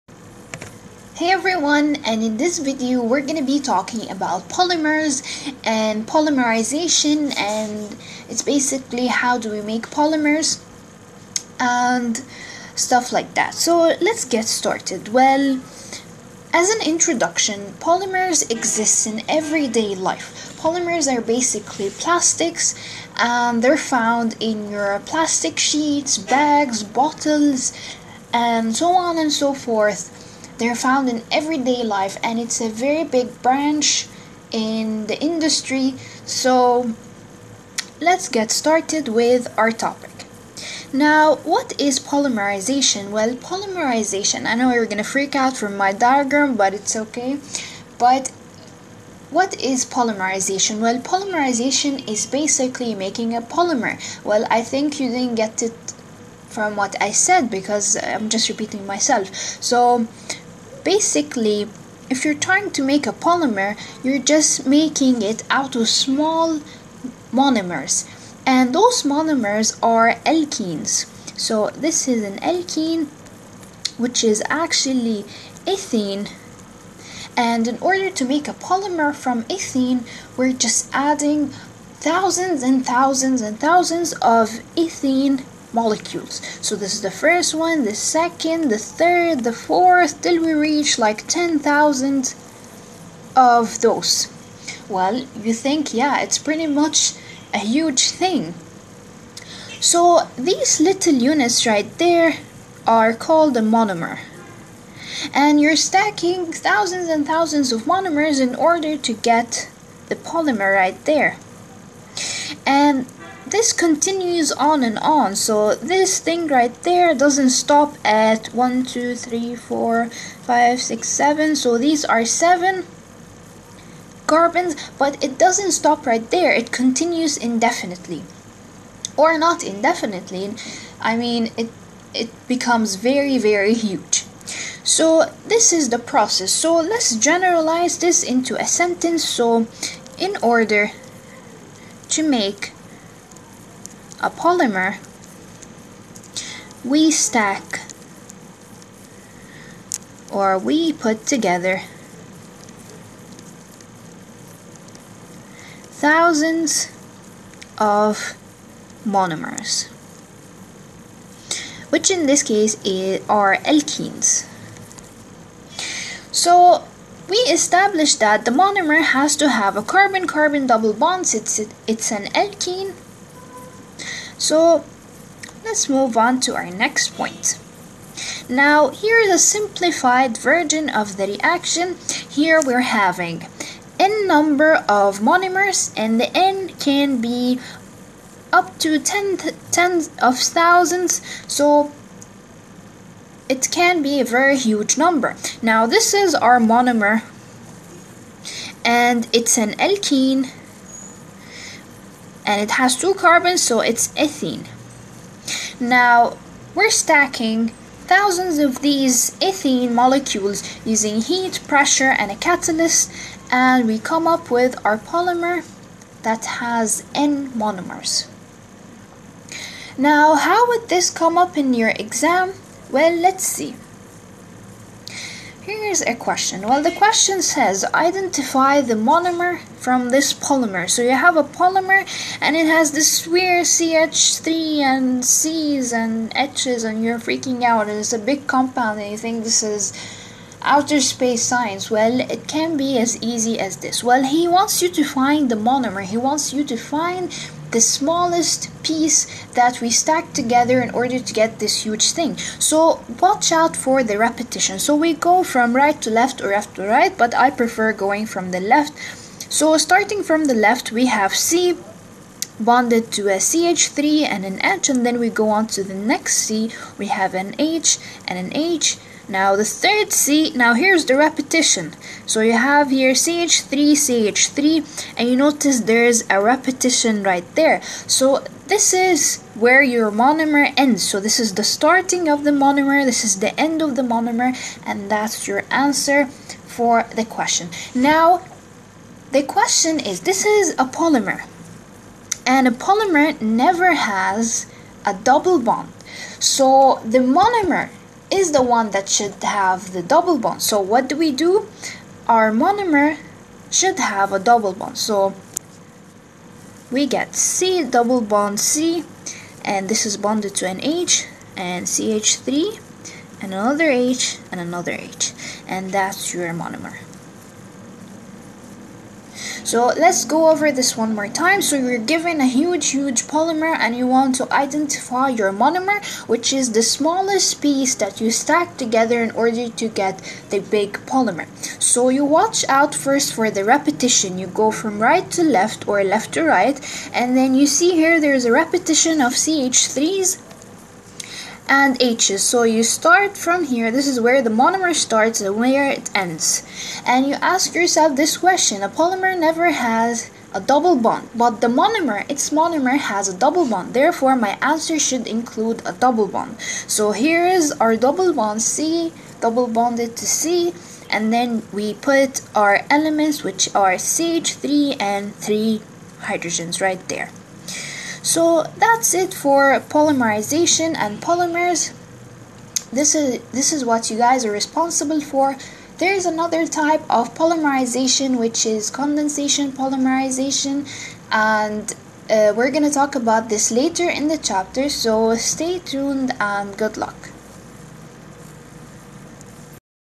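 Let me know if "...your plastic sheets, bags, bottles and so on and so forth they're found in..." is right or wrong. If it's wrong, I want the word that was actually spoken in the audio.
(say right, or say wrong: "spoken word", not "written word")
right.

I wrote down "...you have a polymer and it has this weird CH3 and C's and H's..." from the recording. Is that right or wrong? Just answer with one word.
right.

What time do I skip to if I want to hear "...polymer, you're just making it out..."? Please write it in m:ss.
1:03.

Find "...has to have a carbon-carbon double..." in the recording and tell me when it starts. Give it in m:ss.
2:49.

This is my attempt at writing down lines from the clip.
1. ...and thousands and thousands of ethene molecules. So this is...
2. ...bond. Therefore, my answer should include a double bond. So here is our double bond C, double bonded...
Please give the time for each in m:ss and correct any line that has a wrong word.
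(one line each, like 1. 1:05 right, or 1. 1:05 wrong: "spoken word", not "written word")
1. 1:22 right
2. 5:53 right.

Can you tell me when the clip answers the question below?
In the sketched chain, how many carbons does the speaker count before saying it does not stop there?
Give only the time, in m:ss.
2:01.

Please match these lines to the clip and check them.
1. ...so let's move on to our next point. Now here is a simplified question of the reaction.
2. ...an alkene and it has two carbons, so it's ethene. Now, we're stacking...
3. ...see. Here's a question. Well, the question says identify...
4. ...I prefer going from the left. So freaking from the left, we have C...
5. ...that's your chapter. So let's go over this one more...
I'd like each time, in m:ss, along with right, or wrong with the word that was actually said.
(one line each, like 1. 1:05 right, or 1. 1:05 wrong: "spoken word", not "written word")
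1. 2:54 wrong: "version", not "question"
2. 3:19 right
3. 3:43 right
4. 4:17 wrong: "starting", not "freaking"
5. 5:15 wrong: "monomer", not "chapter".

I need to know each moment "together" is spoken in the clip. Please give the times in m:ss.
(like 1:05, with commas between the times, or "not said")
2:31, 4:10, 5:28.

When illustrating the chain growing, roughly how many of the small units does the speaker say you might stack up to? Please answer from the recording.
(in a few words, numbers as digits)
10,000.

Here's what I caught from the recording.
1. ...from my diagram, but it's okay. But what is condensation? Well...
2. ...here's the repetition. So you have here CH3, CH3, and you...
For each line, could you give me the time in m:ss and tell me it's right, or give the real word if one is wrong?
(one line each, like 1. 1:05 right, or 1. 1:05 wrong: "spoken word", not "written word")
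1. 0:45 wrong: "polymerization", not "condensation"
2. 4:30 right.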